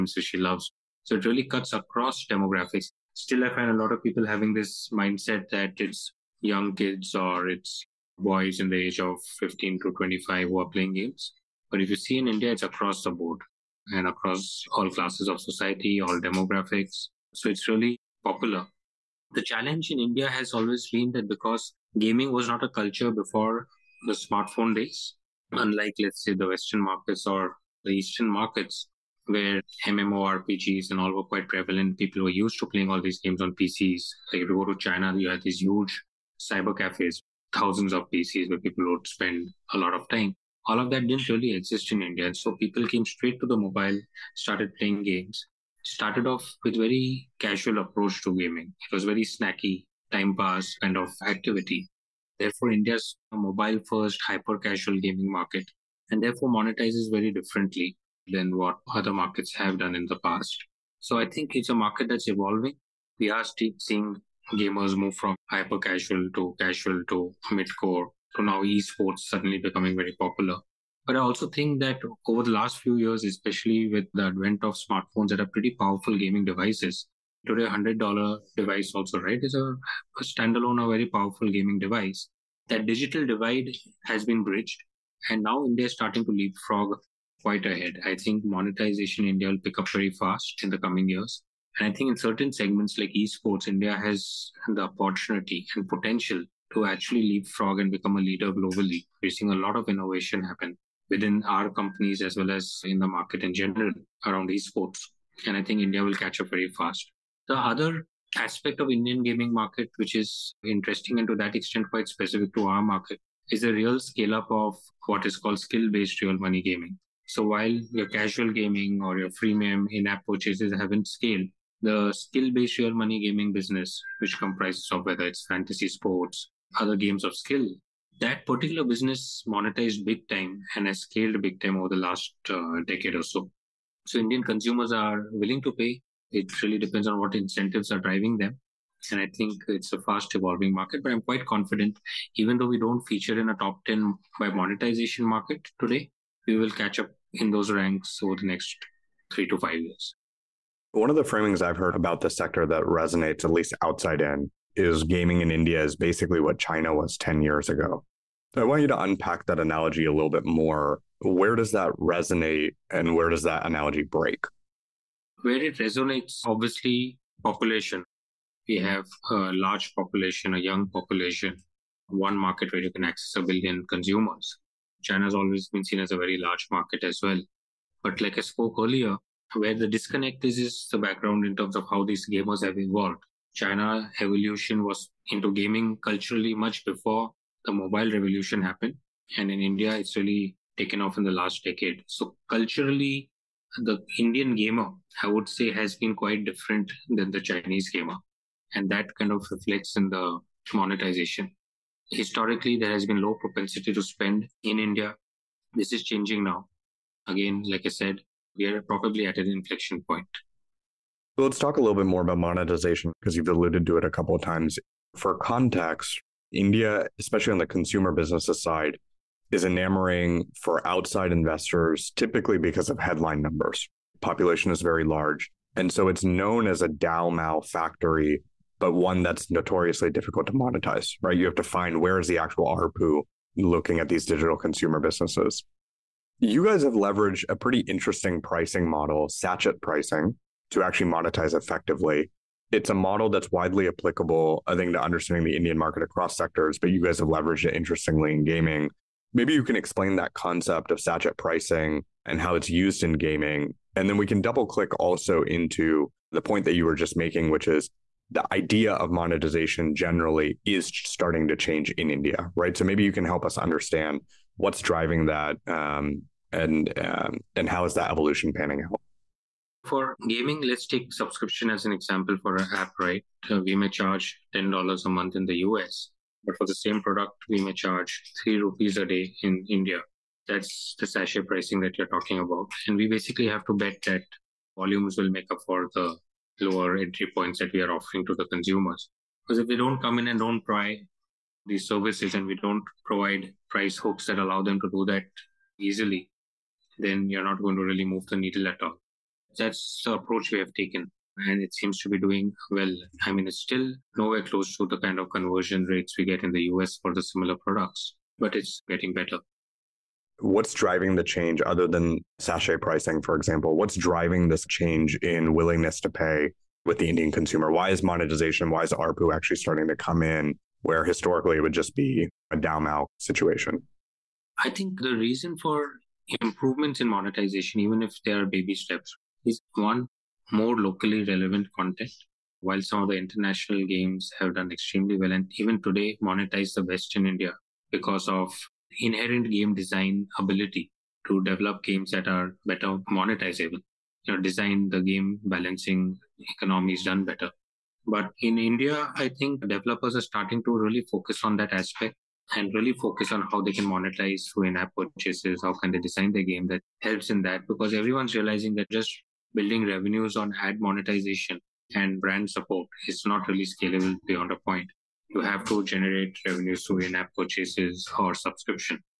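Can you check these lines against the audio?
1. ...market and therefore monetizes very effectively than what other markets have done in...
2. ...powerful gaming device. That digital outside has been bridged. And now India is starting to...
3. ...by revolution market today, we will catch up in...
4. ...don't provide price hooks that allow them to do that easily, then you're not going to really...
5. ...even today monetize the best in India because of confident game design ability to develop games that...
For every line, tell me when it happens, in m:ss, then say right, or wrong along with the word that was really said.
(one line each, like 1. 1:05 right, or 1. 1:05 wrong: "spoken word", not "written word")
1. 0:55 wrong: "differently", not "effectively"
2. 1:21 wrong: "divide", not "outside"
3. 2:24 wrong: "monetization", not "revolution"
4. 4:52 right
5. 5:35 wrong: "inherent", not "confident".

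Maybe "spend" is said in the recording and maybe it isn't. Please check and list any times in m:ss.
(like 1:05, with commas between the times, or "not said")
0:39, 3:24.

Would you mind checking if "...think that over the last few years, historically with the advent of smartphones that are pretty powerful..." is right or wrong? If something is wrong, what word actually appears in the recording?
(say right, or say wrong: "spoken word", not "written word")
wrong: "especially", not "historically".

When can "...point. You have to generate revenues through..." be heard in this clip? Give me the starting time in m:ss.
6:04.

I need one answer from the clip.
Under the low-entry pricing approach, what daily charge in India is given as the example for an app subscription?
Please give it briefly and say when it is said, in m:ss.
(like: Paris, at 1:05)
3 rupees a day, at 4:38.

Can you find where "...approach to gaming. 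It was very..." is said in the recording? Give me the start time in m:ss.
0:47.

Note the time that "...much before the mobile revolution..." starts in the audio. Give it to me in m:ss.
3:06.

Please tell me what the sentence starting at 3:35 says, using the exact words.
For context, India, especially on the consumer business side, is enamoring for outside investors, typically because of headline numbers.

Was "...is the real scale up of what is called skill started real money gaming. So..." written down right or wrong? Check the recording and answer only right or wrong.
wrong.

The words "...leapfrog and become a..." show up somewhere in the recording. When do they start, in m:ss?
1:37.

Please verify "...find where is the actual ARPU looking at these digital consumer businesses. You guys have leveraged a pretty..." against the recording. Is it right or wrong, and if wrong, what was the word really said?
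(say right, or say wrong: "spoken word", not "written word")
right.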